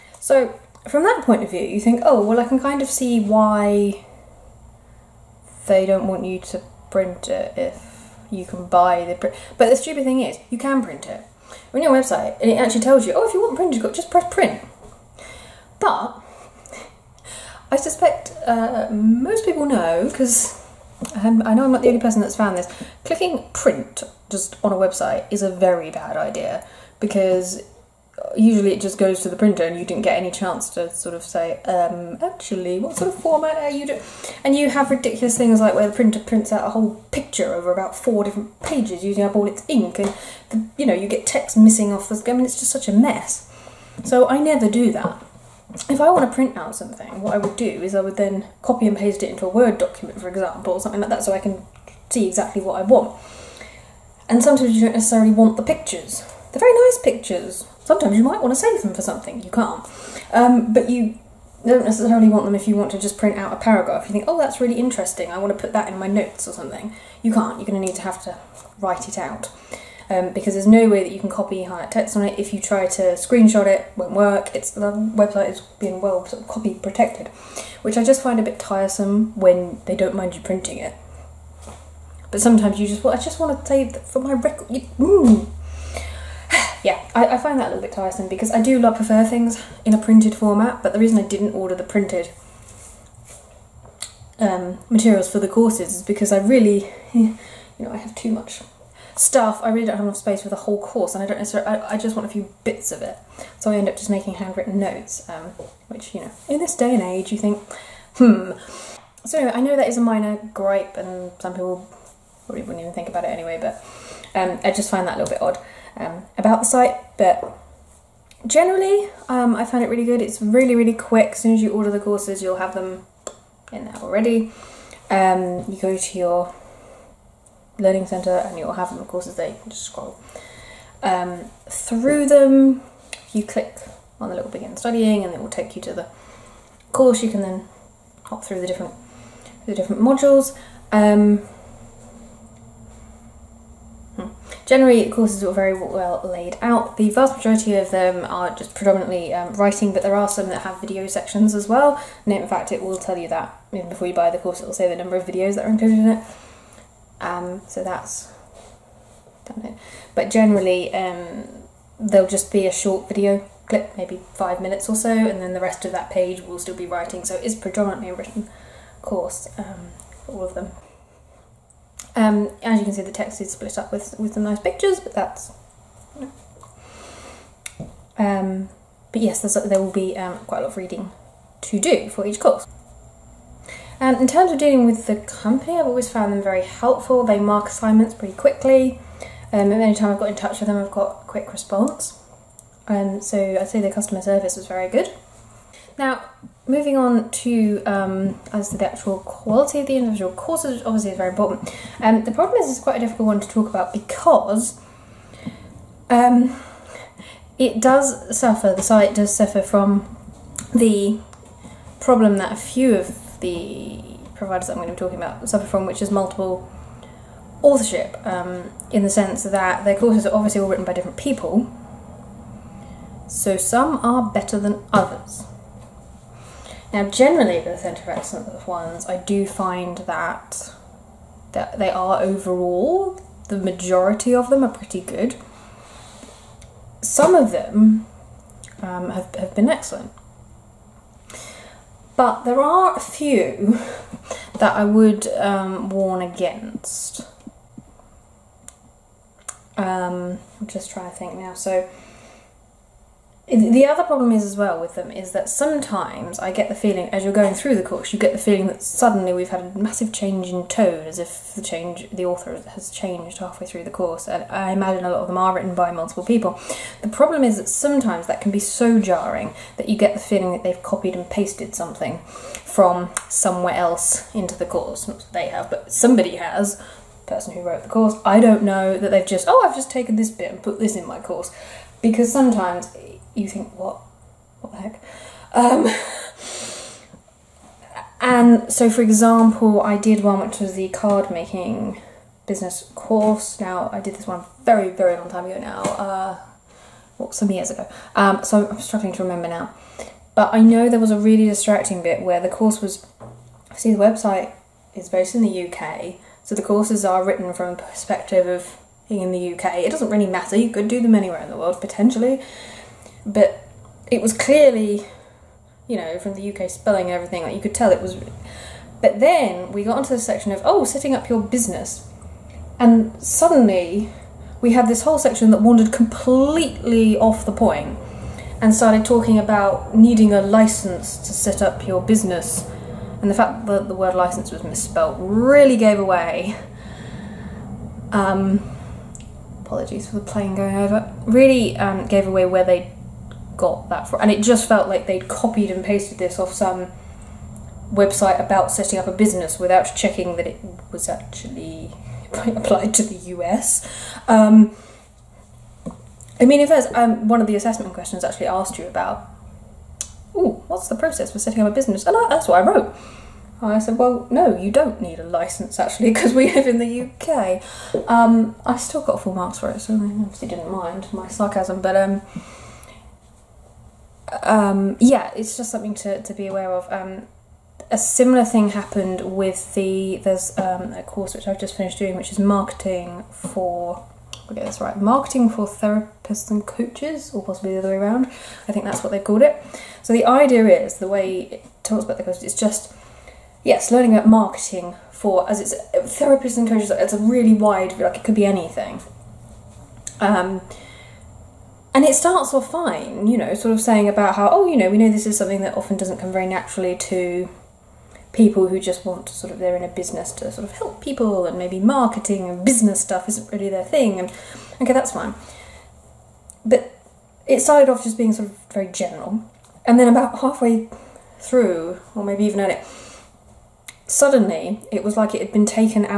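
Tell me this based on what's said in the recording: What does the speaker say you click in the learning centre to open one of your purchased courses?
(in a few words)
begin studying.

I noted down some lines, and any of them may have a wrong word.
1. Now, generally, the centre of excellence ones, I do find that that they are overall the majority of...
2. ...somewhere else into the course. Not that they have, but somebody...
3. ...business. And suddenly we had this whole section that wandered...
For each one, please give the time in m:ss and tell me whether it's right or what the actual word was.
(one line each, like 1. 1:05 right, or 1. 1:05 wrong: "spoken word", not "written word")
1. 3:46 right
2. 4:33 right
3. 5:21 right.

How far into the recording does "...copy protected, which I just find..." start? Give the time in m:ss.
1:16.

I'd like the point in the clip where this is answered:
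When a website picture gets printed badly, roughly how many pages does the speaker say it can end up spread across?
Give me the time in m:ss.
0:37.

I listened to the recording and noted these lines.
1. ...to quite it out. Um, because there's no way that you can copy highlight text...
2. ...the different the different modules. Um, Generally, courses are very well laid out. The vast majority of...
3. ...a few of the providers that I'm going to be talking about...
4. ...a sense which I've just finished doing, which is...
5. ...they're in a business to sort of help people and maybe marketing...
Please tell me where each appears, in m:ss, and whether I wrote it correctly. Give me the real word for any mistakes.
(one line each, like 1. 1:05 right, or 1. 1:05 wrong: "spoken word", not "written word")
1. 1:08 wrong: "write", not "quite"
2. 2:18 right
3. 3:32 right
4. 6:20 wrong: "course", not "sense"
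5. 6:49 right.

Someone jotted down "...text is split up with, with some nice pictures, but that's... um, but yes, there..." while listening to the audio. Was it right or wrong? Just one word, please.
right.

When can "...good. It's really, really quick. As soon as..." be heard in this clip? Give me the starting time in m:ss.
2:00.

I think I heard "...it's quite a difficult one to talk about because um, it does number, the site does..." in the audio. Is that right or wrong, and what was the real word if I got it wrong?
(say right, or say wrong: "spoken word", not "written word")
wrong: "suffer", not "number".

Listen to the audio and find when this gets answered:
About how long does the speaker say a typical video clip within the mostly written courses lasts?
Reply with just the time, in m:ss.
2:44.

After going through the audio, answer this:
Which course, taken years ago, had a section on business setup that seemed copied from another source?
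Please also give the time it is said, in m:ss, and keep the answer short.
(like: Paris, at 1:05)
card making business, at 4:50.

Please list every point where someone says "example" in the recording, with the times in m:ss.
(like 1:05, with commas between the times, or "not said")
0:50, 4:49.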